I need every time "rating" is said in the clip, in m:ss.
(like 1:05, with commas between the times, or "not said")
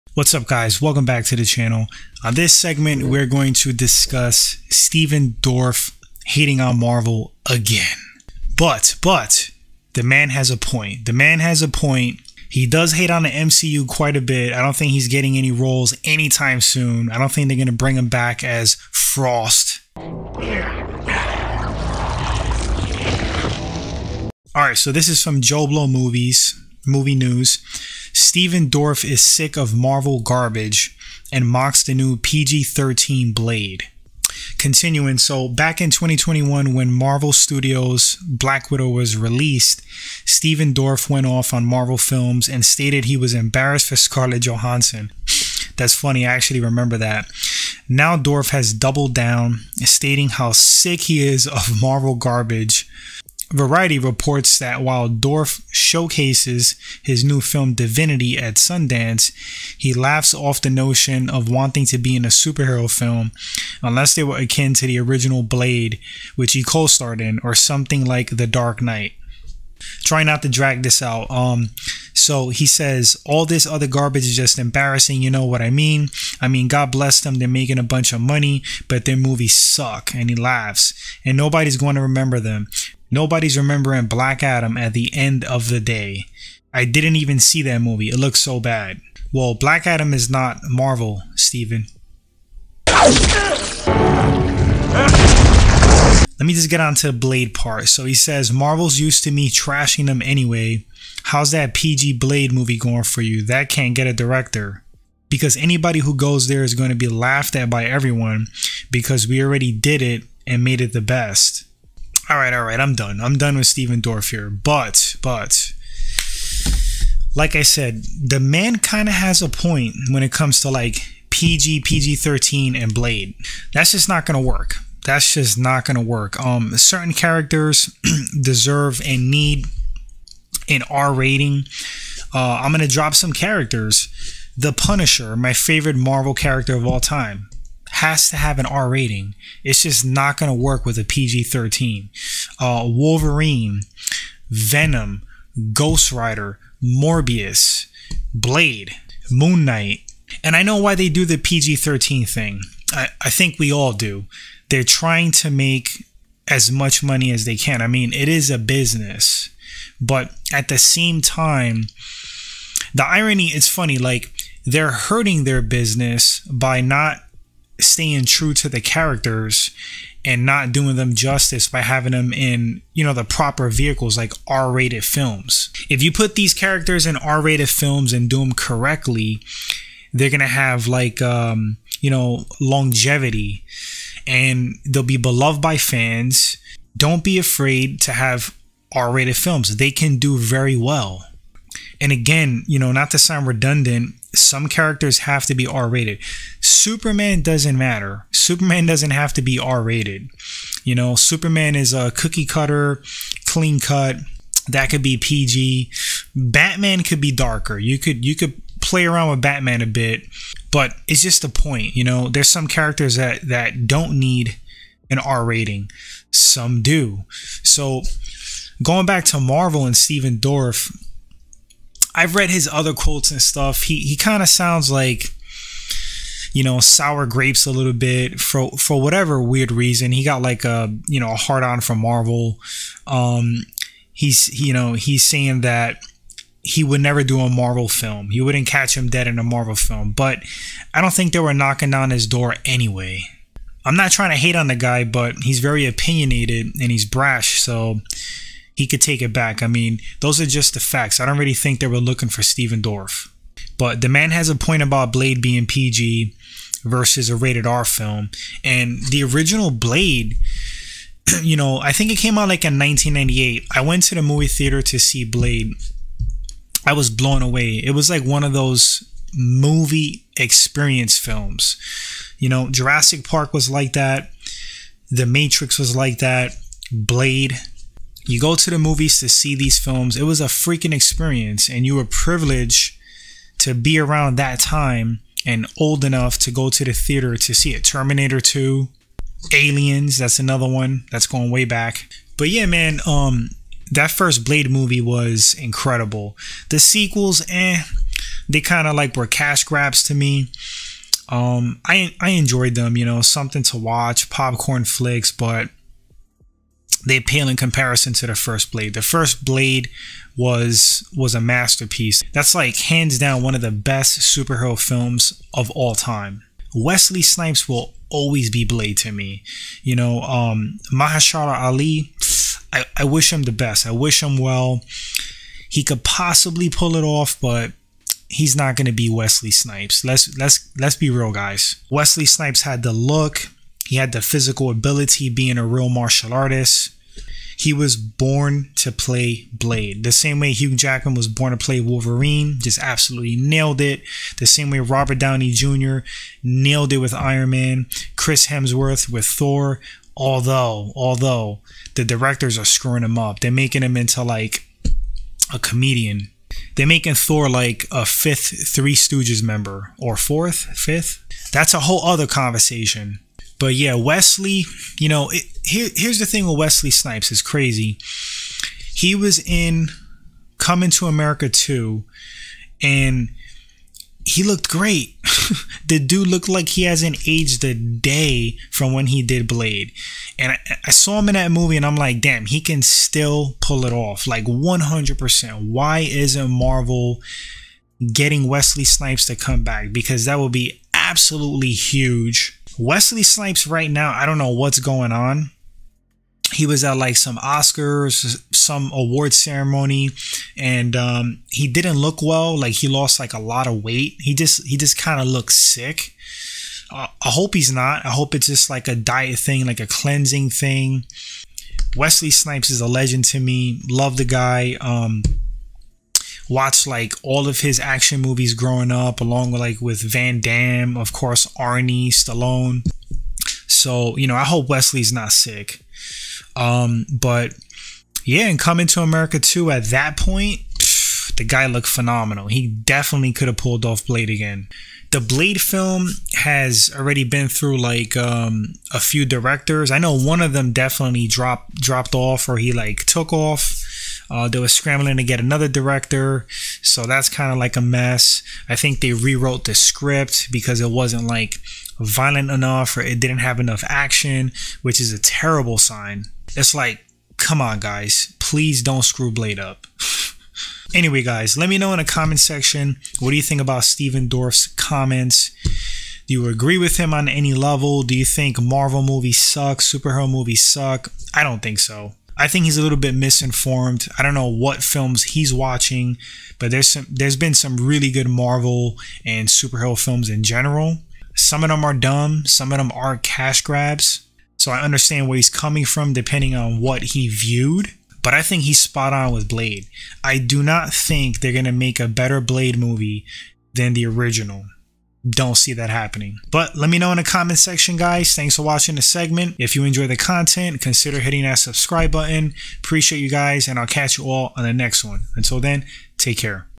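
2:11, 2:18, 3:35.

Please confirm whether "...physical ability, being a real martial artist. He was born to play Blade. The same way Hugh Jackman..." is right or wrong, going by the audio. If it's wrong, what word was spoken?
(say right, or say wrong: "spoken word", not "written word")
right.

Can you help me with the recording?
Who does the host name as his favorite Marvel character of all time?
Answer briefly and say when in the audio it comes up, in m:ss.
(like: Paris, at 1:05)
The Punisher, at 2:14.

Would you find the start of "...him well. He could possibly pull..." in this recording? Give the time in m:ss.
5:24.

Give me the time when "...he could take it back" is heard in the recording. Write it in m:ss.
4:08.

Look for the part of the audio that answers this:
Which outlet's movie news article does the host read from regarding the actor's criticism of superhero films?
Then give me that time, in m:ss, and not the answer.
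0:25.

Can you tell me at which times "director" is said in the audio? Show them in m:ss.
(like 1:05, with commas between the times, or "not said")
1:44, 5:52, 7:19, 7:25.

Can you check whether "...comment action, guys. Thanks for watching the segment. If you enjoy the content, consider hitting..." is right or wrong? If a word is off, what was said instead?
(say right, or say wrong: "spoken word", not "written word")
wrong: "section", not "action".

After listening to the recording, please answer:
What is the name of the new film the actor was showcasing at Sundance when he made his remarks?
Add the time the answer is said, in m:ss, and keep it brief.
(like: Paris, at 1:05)
Divinity, at 0:57.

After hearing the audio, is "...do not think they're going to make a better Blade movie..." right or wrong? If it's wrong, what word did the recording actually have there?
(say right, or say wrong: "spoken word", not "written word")
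right.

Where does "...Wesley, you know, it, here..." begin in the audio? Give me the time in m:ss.
6:03.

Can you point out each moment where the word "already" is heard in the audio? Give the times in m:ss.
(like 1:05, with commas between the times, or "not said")
1:49, 7:16.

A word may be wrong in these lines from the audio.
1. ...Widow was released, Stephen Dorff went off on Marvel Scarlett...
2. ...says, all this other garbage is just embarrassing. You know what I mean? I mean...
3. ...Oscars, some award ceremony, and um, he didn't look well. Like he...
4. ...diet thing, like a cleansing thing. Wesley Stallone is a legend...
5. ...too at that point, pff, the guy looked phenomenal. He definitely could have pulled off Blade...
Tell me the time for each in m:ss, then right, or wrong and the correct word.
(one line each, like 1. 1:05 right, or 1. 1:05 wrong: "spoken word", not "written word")
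1. 0:38 wrong: "Films", not "Scarlett"
2. 1:12 right
3. 6:37 right
4. 6:48 wrong: "Snipes", not "Stallone"
5. 7:09 right.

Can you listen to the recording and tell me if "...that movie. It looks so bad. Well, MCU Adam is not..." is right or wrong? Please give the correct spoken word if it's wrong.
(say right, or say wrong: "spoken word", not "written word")
wrong: "Black", not "MCU".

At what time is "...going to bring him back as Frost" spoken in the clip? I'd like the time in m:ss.
0:17.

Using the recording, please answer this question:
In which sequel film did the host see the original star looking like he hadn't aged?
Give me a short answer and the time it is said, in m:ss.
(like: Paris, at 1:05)
Coming to America 2, at 6:10.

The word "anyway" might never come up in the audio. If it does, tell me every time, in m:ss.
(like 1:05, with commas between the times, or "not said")
1:40, 4:02, 7:40.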